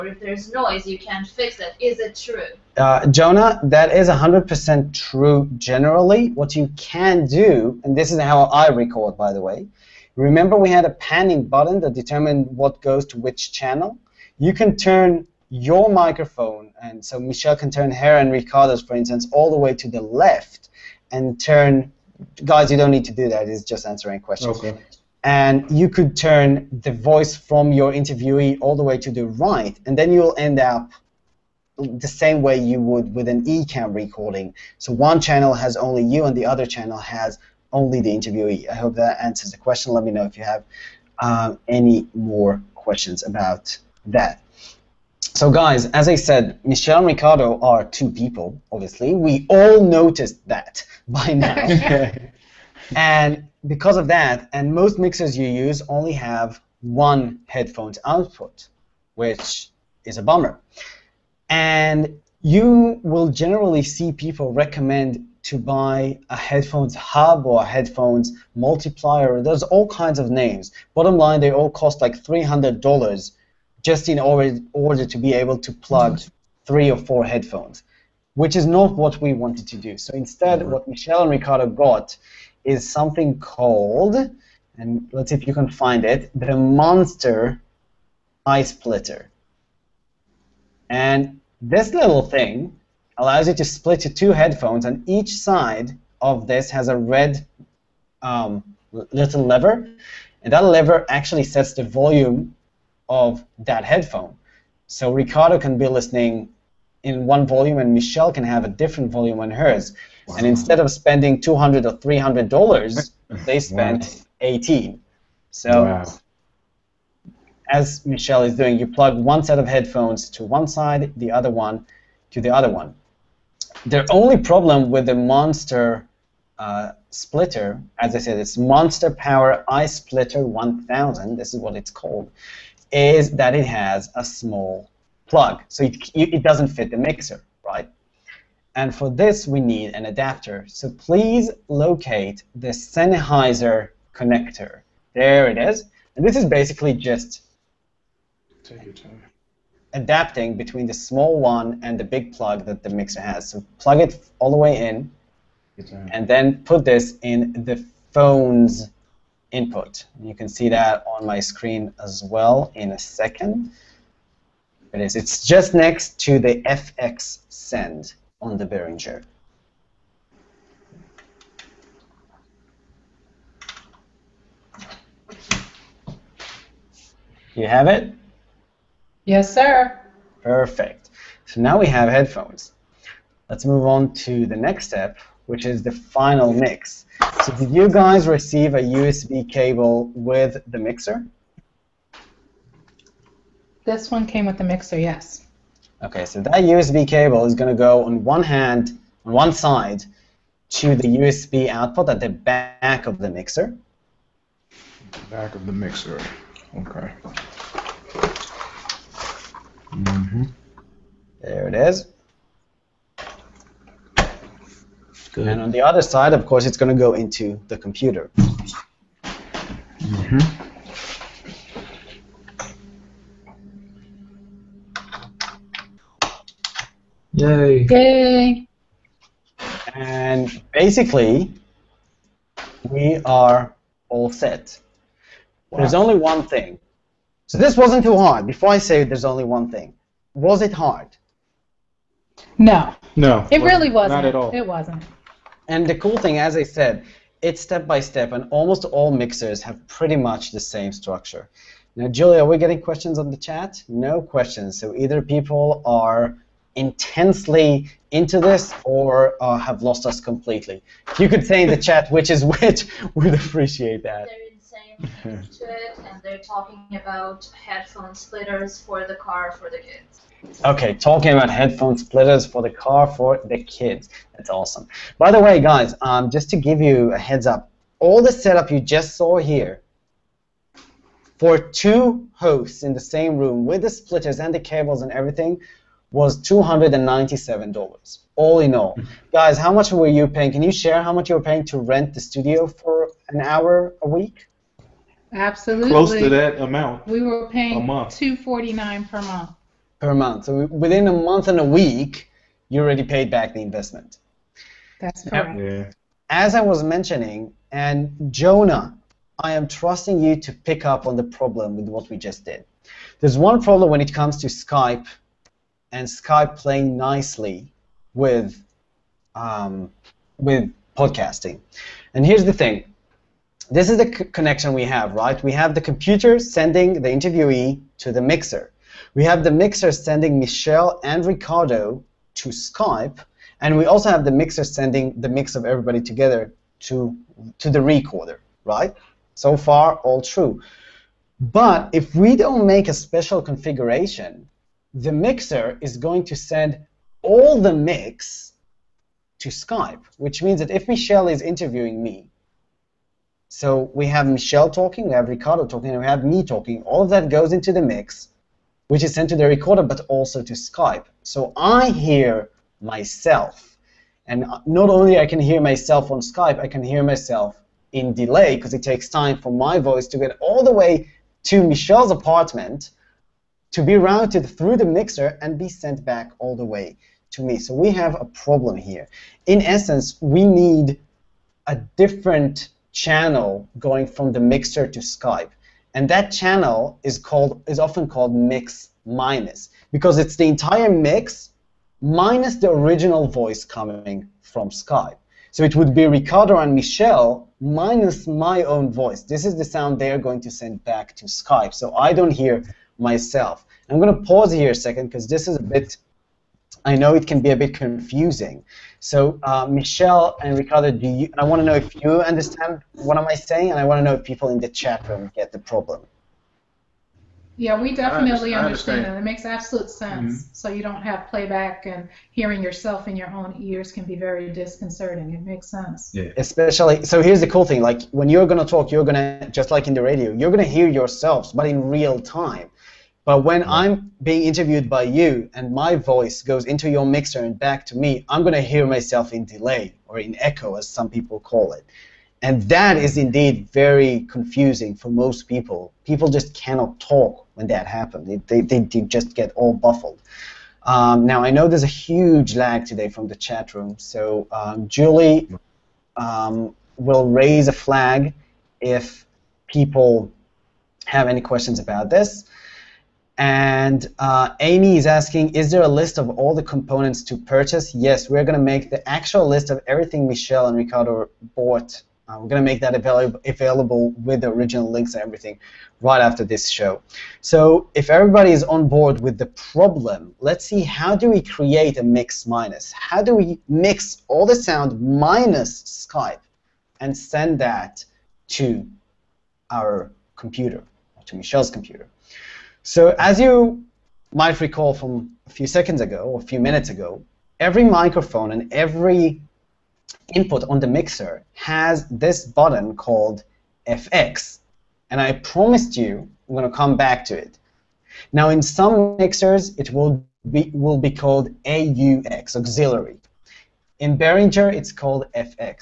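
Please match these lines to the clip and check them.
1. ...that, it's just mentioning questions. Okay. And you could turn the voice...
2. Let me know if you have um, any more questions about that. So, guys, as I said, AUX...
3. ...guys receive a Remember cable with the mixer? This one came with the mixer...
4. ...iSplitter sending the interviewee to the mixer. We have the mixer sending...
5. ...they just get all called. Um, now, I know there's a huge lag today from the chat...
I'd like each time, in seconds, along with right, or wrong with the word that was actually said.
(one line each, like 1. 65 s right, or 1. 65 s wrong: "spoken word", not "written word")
1. 23 s wrong: "answering", not "mentioning"
2. 39 s wrong: "Michelle", not "AUX"
3. 187 s wrong: "USB", not "Remember"
4. 325 s wrong: "computer", not "iSplitter"
5. 448 s wrong: "baffled", not "called".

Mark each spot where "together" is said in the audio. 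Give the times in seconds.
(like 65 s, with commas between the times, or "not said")
336 s.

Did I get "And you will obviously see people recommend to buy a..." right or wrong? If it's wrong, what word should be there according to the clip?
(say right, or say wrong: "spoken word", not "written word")
wrong: "generally", not "obviously".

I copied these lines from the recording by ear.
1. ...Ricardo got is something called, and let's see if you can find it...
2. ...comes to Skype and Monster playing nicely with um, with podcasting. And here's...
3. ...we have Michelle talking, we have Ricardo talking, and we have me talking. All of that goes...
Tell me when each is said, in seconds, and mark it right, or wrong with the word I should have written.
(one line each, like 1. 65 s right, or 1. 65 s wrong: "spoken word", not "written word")
1. 81 s right
2. 314 s wrong: "Skype", not "Monster"
3. 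353 s right.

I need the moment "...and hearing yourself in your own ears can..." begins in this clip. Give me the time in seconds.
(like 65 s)
421 s.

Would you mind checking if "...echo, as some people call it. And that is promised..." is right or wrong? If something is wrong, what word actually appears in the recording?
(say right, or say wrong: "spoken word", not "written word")
wrong: "indeed", not "promised".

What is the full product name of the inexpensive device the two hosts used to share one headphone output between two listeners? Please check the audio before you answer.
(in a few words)
Monster Power iSplitter 1000.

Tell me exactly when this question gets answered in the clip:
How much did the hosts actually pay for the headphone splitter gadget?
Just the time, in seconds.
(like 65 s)
114 s.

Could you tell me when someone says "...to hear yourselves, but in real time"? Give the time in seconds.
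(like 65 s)
430 s.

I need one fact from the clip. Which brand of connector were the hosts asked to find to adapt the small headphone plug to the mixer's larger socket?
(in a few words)
Sennheiser.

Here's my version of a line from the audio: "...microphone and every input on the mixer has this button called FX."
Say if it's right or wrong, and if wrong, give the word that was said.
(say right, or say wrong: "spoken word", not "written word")
right.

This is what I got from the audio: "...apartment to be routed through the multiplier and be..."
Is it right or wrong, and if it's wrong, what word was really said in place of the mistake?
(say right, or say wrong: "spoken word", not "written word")
wrong: "mixer", not "multiplier".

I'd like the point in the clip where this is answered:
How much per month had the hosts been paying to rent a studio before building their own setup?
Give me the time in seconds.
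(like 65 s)
298 s.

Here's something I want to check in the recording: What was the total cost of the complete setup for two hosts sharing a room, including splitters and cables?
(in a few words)
$297.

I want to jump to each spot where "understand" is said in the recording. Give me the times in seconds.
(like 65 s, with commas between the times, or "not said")
412 s, 418 s.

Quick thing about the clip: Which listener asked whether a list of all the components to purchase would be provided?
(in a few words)
Amy.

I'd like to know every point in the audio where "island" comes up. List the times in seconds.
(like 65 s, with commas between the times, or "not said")
not said.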